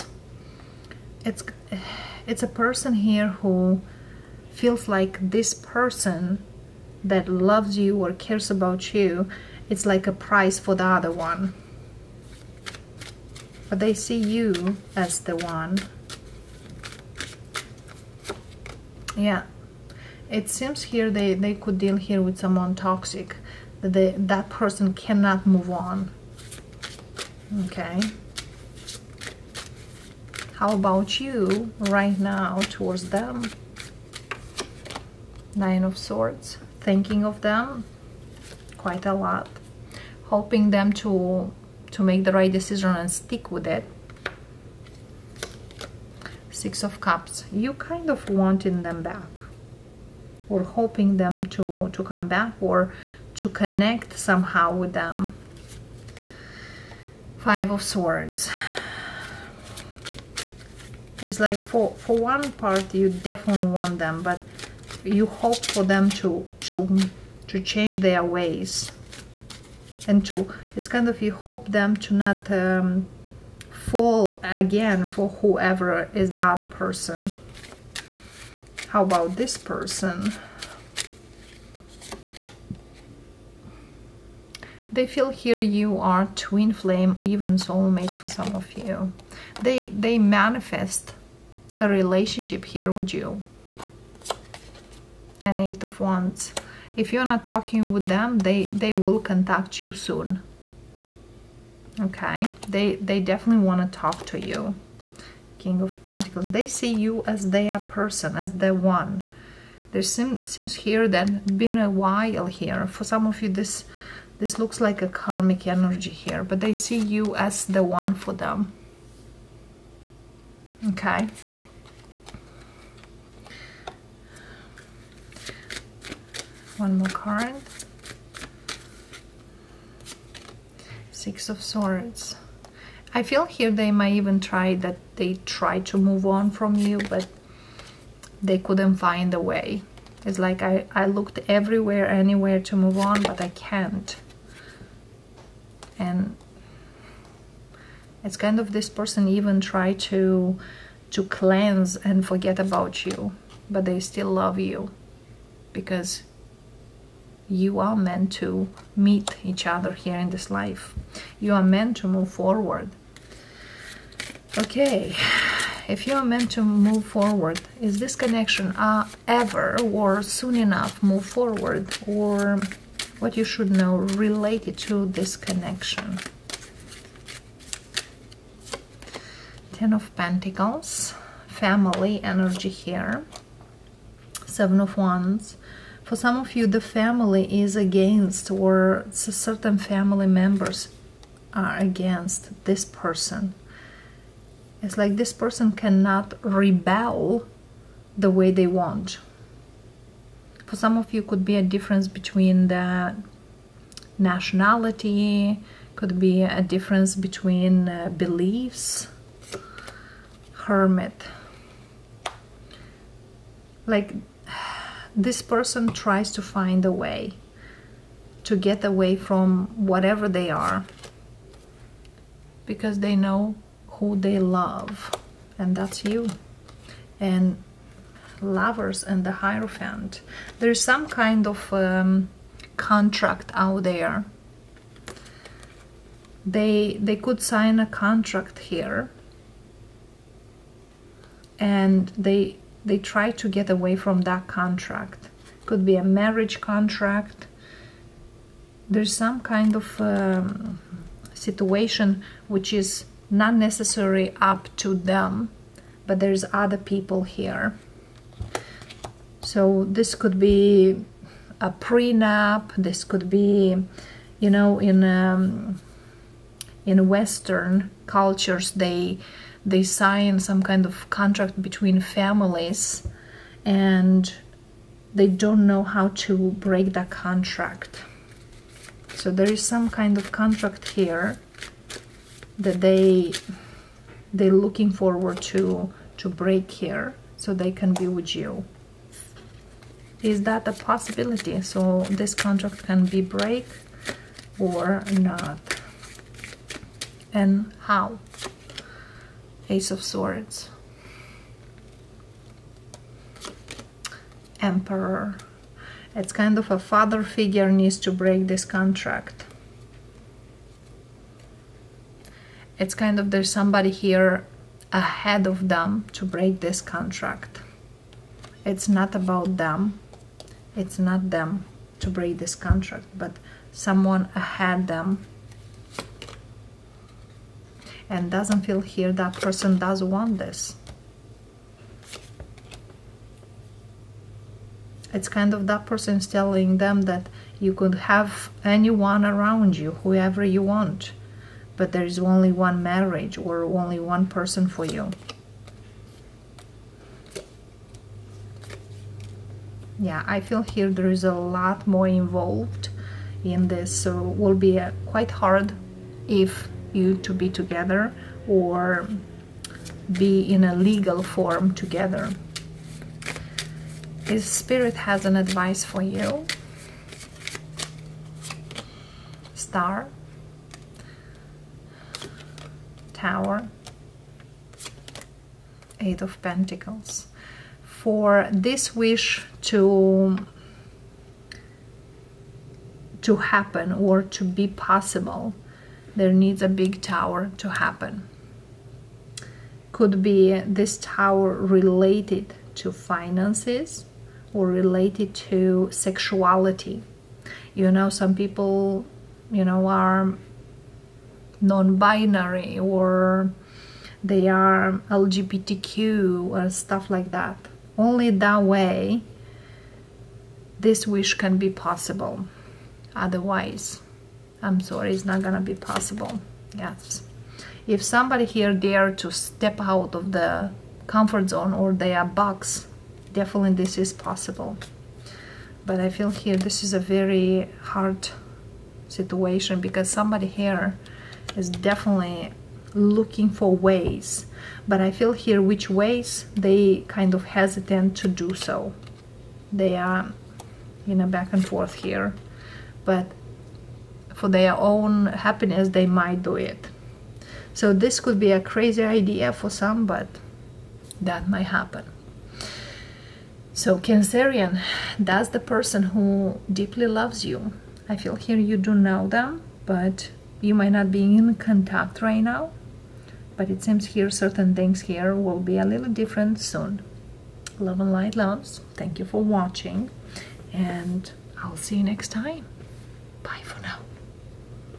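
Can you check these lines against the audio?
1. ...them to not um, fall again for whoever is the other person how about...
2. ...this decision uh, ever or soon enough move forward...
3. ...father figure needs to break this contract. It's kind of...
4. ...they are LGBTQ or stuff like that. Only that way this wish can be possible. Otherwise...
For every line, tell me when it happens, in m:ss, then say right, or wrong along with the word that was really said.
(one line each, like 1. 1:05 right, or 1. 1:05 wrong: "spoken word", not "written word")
1. 1:11 right
2. 2:47 wrong: "connection", not "decision"
3. 5:06 right
4. 6:44 right.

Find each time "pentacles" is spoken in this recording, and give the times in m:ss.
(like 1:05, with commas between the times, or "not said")
1:46, 3:00, 6:16.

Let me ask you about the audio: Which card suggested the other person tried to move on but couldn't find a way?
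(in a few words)
Six of Swords.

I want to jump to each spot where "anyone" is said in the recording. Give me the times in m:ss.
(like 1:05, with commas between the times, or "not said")
5:38.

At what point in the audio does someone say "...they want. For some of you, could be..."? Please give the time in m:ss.
3:18.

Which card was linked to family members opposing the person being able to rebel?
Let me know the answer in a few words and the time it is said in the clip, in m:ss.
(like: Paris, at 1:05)
Seven of Wands, at 3:04.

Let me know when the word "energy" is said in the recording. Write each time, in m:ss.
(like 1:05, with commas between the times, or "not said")
1:55, 3:02.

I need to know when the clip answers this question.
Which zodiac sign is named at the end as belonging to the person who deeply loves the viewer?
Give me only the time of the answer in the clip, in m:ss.
7:33.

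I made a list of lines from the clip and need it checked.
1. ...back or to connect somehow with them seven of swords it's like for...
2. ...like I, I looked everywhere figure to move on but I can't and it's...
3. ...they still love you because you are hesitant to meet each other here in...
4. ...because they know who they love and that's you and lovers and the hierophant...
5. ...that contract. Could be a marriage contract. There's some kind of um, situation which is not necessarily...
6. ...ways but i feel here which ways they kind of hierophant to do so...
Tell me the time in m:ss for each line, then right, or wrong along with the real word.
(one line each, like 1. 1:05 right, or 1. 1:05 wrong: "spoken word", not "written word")
1. 0:52 wrong: "five", not "seven"
2. 2:20 wrong: "anywhere", not "figure"
3. 2:33 wrong: "meant", not "hesitant"
4. 3:42 right
5. 4:04 right
6. 7:13 wrong: "hesitant", not "hierophant".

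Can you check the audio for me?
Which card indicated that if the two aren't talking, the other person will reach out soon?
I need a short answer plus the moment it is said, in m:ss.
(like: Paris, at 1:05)
Eight of Wands, at 1:35.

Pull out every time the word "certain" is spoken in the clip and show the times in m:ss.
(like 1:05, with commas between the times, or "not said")
3:09, 7:44.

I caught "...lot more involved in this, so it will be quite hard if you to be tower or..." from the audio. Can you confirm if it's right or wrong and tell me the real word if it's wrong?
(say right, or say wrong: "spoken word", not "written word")
wrong: "together", not "tower".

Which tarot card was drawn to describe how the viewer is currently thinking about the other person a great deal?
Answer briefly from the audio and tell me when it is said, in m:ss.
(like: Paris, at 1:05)
Nine of Swords, at 0:35.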